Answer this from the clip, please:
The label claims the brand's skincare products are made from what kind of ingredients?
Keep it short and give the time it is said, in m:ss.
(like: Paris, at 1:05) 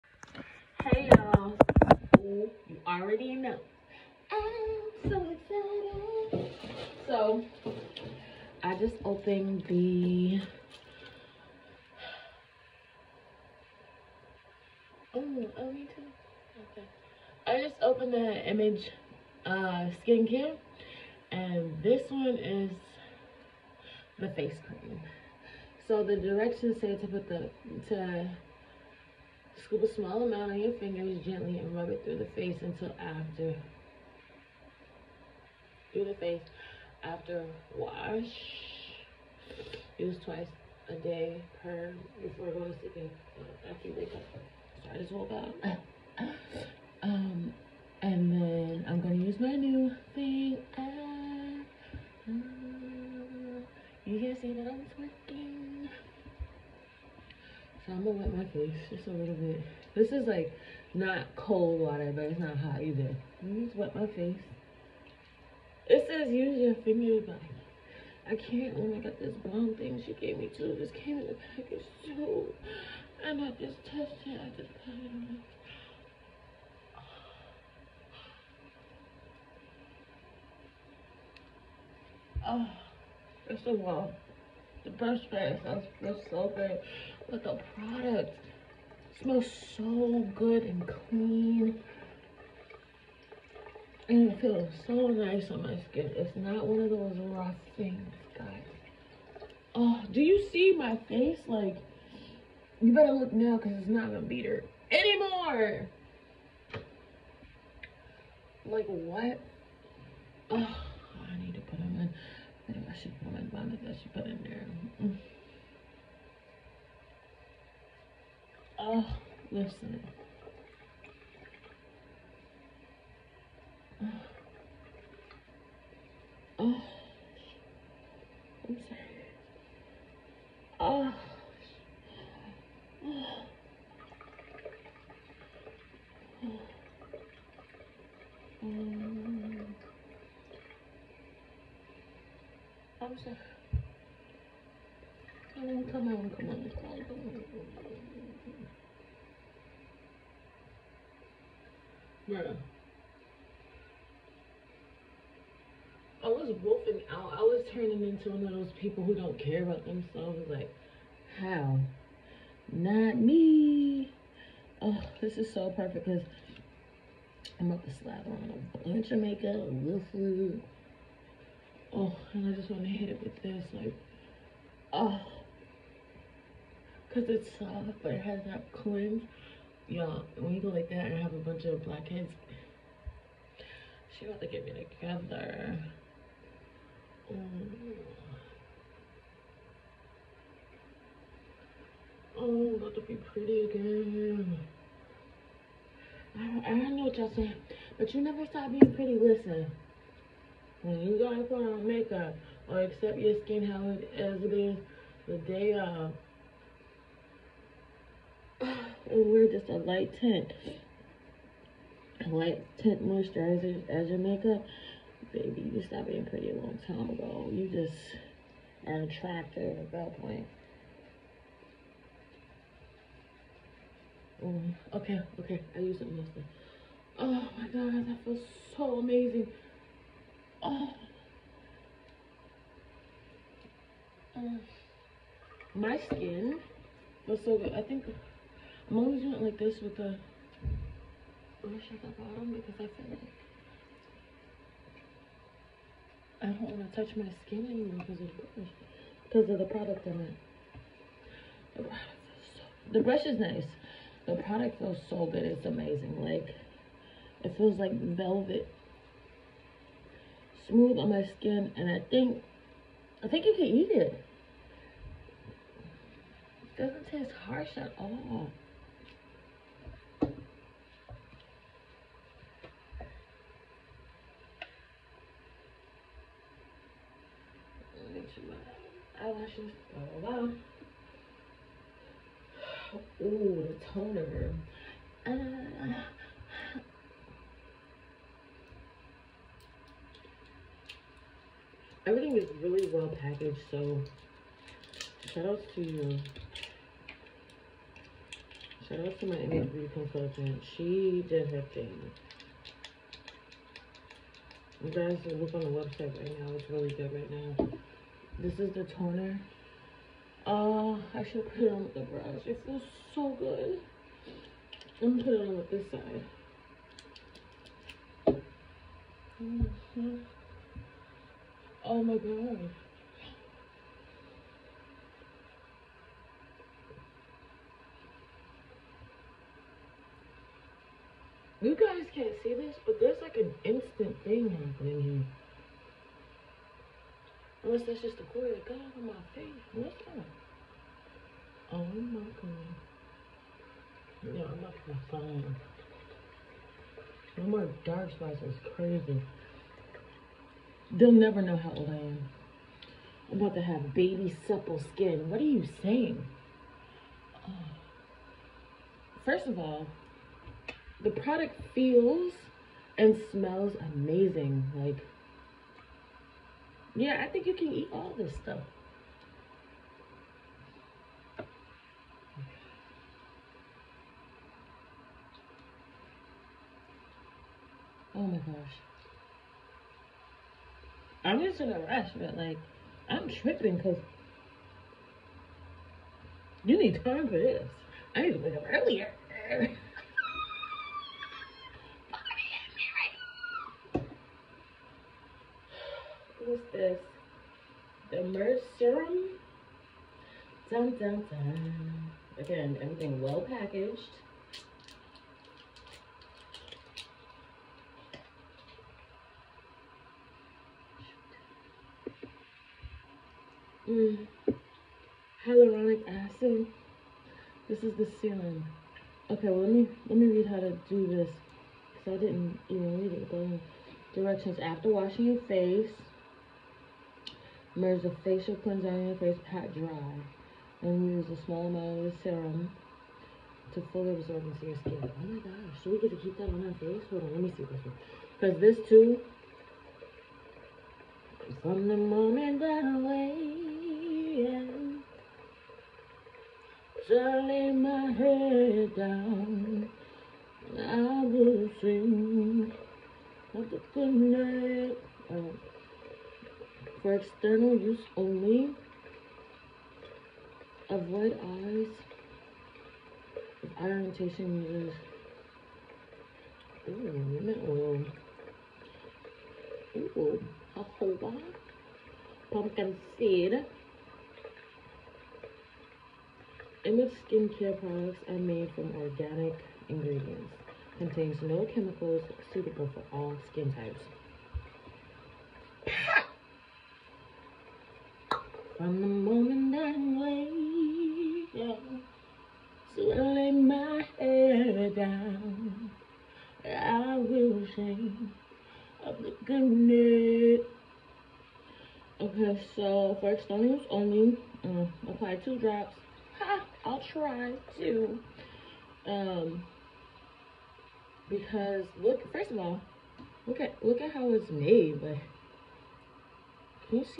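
organic ingredients, at 7:59.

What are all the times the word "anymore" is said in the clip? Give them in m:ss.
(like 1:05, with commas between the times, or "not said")
1:44, 4:07.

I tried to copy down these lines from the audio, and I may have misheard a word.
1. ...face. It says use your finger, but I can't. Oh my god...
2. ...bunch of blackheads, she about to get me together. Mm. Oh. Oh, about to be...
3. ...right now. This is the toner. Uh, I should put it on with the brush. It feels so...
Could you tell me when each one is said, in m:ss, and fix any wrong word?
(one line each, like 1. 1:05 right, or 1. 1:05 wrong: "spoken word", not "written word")
1. 1:04 right
2. 3:01 right
3. 5:07 right.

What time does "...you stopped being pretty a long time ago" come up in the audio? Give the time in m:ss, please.
3:35.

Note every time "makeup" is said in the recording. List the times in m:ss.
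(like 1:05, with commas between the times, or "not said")
2:49, 3:21, 3:34.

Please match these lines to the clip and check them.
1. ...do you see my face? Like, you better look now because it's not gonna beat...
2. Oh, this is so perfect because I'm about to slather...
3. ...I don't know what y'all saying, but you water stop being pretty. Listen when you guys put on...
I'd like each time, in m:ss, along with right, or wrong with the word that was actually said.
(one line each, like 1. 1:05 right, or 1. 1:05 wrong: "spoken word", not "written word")
1. 1:40 right
2. 2:44 right
3. 3:16 wrong: "never", not "water".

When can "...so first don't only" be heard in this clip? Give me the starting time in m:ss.
8:22.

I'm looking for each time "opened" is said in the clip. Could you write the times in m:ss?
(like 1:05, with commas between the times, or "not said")
0:09, 0:17.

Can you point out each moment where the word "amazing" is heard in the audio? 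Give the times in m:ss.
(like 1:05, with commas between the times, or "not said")
4:15, 6:03.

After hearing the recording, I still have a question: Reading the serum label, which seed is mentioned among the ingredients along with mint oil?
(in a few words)
Pumpkin seed.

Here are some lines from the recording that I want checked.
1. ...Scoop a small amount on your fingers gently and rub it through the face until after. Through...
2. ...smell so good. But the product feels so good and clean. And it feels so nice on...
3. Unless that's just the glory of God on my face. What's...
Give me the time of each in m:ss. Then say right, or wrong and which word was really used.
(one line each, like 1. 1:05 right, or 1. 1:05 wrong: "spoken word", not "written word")
1. 0:29 right
2. 1:25 wrong: "smells", not "feels"
3. 5:37 right.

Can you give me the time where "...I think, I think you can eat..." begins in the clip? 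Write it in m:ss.
4:21.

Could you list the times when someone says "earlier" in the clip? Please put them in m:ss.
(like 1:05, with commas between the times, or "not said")
6:28.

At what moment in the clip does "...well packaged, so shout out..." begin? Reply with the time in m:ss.
4:52.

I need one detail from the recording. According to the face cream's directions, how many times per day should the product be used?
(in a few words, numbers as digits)
twice a day.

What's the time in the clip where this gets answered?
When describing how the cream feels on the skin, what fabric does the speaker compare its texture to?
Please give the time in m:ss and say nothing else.
4:17.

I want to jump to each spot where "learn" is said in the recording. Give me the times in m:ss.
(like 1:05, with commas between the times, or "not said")
not said.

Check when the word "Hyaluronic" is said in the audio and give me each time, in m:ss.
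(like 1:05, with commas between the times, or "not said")
6:55.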